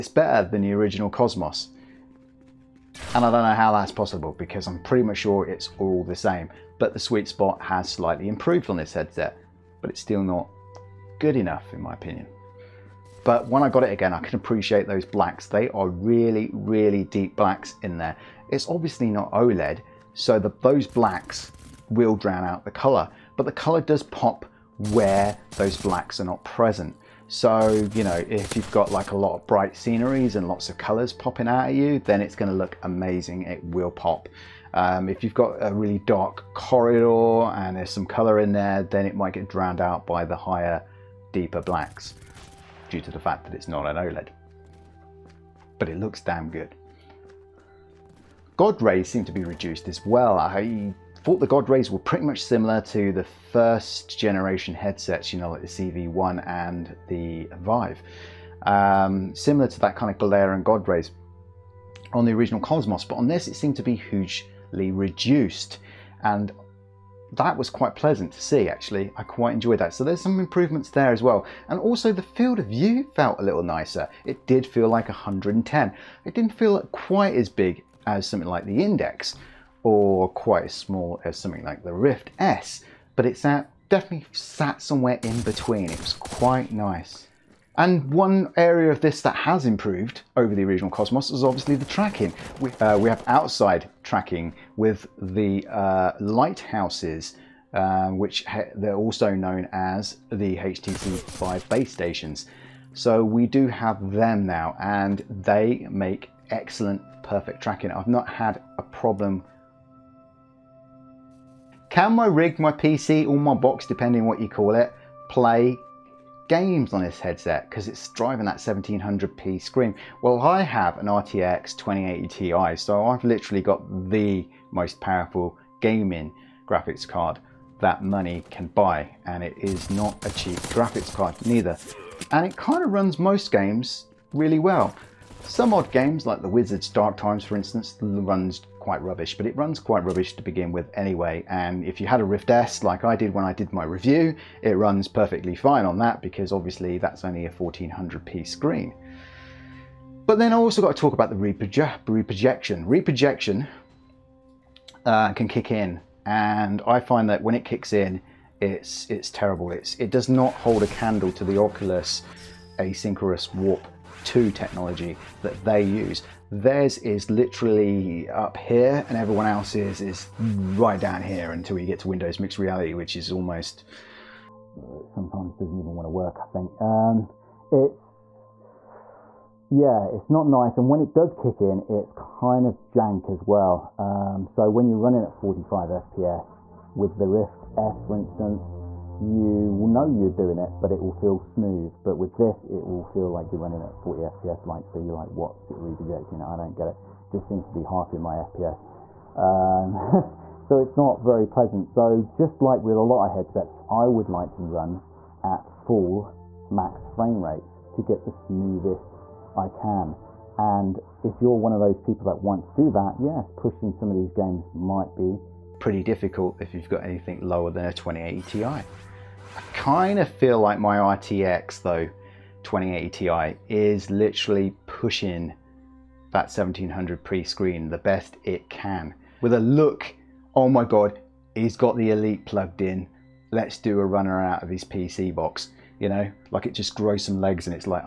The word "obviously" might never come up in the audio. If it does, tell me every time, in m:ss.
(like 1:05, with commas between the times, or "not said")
0:18, 1:31, 2:26.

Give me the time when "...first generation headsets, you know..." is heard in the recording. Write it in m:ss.
0:53.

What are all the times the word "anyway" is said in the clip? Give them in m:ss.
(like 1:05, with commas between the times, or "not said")
2:20.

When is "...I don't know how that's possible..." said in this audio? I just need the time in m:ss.
0:03.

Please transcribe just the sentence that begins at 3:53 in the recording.
Let's do a runner out of his PC box.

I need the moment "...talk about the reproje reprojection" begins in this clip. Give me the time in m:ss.
2:30.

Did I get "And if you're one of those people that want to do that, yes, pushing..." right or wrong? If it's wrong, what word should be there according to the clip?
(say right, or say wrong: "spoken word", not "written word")
right.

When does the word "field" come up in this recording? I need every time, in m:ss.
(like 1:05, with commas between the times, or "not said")
1:12.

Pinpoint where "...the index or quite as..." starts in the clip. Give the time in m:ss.
1:18.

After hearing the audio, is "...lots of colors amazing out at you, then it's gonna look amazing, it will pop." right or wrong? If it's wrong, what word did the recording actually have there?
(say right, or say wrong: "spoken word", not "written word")
wrong: "popping", not "amazing".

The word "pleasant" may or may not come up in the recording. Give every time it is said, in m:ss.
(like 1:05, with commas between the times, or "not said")
1:07, 3:21.